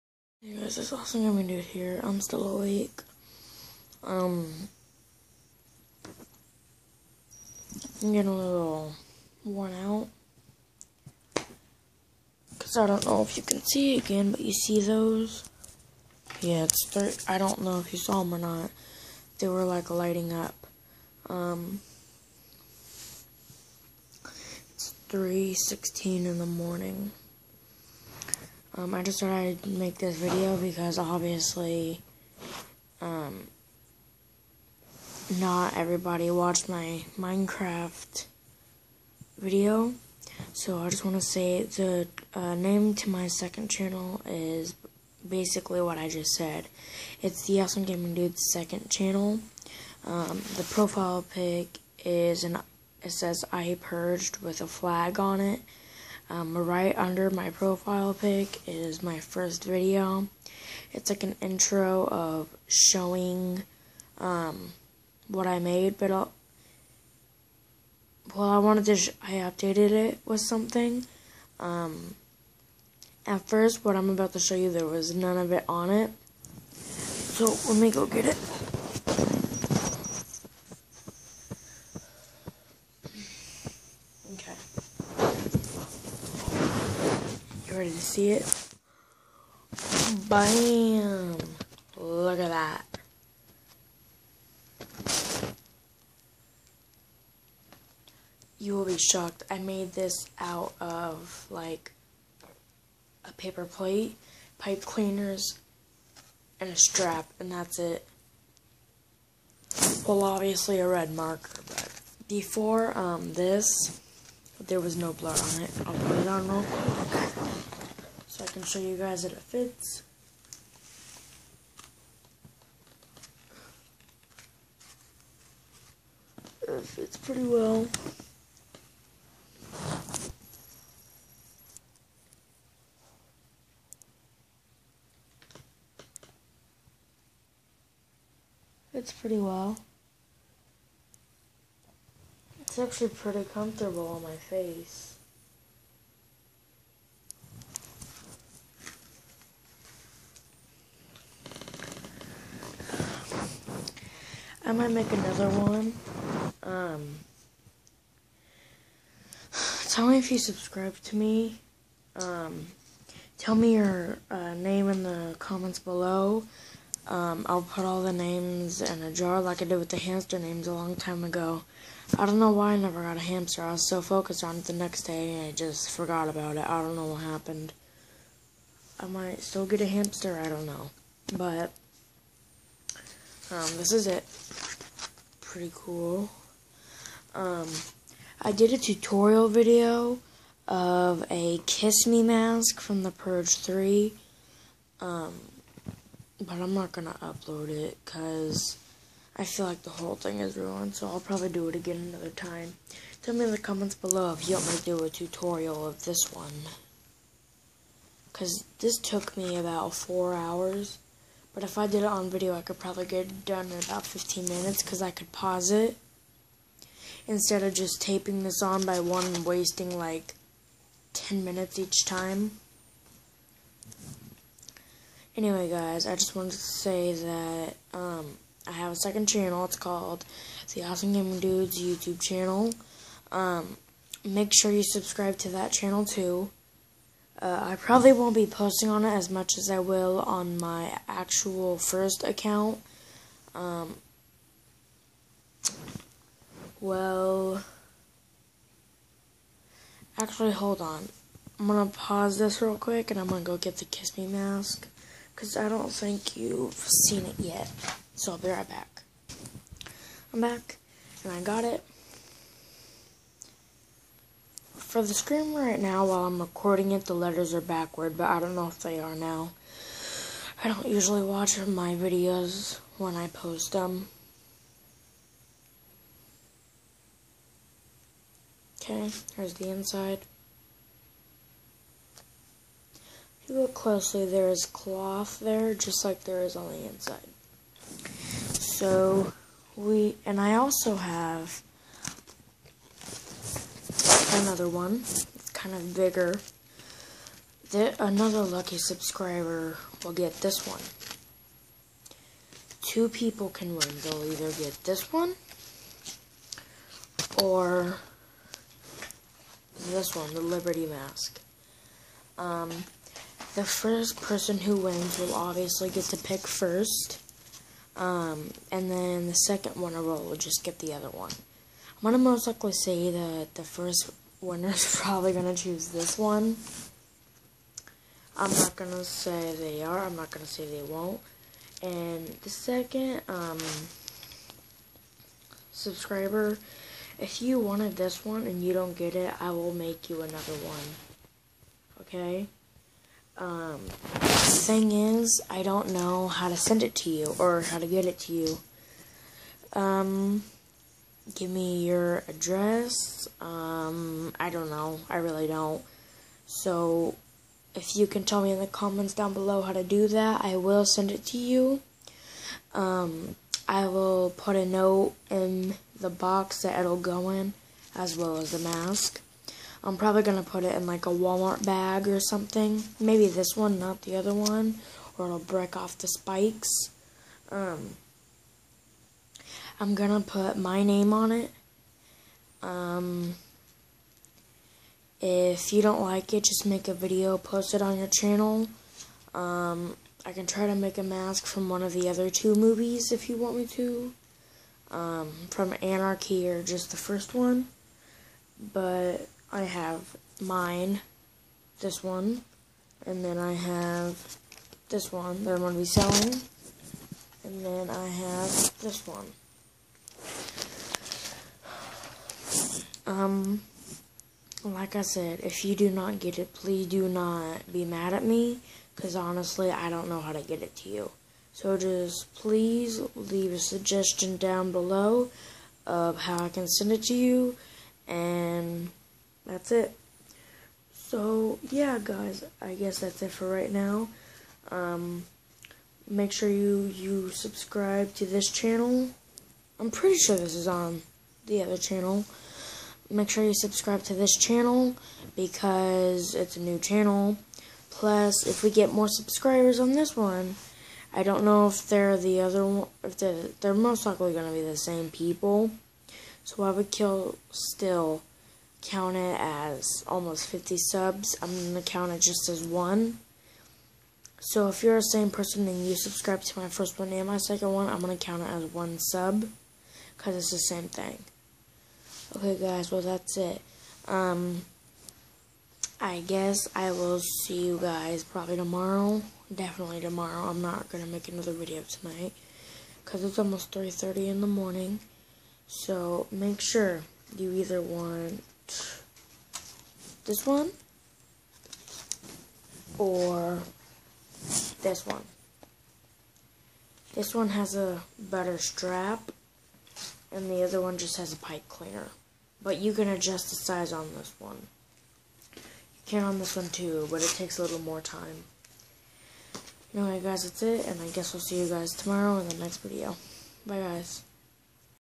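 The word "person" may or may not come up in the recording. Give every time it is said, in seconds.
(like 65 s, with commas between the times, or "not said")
314 s, 465 s.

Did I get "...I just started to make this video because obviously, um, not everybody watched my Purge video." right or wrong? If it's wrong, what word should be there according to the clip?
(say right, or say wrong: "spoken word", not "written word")
wrong: "Minecraft", not "Purge".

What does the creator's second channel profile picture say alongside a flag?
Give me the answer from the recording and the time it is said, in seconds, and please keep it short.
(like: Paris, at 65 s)
I purged, at 53 s.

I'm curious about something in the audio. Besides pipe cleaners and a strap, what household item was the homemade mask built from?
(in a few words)
paper plate.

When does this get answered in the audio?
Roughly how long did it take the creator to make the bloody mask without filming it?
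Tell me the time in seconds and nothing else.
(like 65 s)
209 s.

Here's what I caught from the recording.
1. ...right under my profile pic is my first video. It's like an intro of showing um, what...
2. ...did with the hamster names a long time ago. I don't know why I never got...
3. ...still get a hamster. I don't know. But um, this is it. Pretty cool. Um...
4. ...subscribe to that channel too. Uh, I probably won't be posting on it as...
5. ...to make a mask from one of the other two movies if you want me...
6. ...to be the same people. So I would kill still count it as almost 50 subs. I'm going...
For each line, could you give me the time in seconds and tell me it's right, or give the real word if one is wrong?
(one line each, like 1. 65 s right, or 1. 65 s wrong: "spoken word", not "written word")
1. 56 s right
2. 169 s right
3. 179 s right
4. 234 s right
5. 390 s right
6. 454 s right.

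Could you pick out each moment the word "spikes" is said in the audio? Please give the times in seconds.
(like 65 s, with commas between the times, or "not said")
376 s.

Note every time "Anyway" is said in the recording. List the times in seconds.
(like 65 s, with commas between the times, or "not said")
225 s, 509 s.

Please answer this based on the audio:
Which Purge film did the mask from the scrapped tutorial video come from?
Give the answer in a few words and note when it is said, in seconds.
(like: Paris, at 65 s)
The Purge 3, at 193 s.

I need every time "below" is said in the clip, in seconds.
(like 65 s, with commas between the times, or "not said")
165 s, 203 s, 359 s, 424 s.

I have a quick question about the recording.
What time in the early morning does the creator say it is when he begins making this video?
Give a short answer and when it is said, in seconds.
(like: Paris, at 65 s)
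3:16, at 25 s.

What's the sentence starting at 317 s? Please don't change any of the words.
Um, and then the second winner will just get the other one.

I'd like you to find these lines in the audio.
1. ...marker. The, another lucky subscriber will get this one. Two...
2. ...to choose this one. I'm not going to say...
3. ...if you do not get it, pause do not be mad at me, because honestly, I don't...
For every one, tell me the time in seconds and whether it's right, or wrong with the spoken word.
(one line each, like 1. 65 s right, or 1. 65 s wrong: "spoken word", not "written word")
1. 295 s wrong: "bigger", not "marker"
2. 325 s right
3. 415 s wrong: "please", not "pause".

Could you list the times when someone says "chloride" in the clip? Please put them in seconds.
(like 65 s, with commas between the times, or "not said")
not said.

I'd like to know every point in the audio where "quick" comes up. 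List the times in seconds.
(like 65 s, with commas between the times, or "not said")
116 s, 252 s.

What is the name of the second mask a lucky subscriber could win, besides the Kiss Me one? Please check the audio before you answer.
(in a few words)
Liberty Mask.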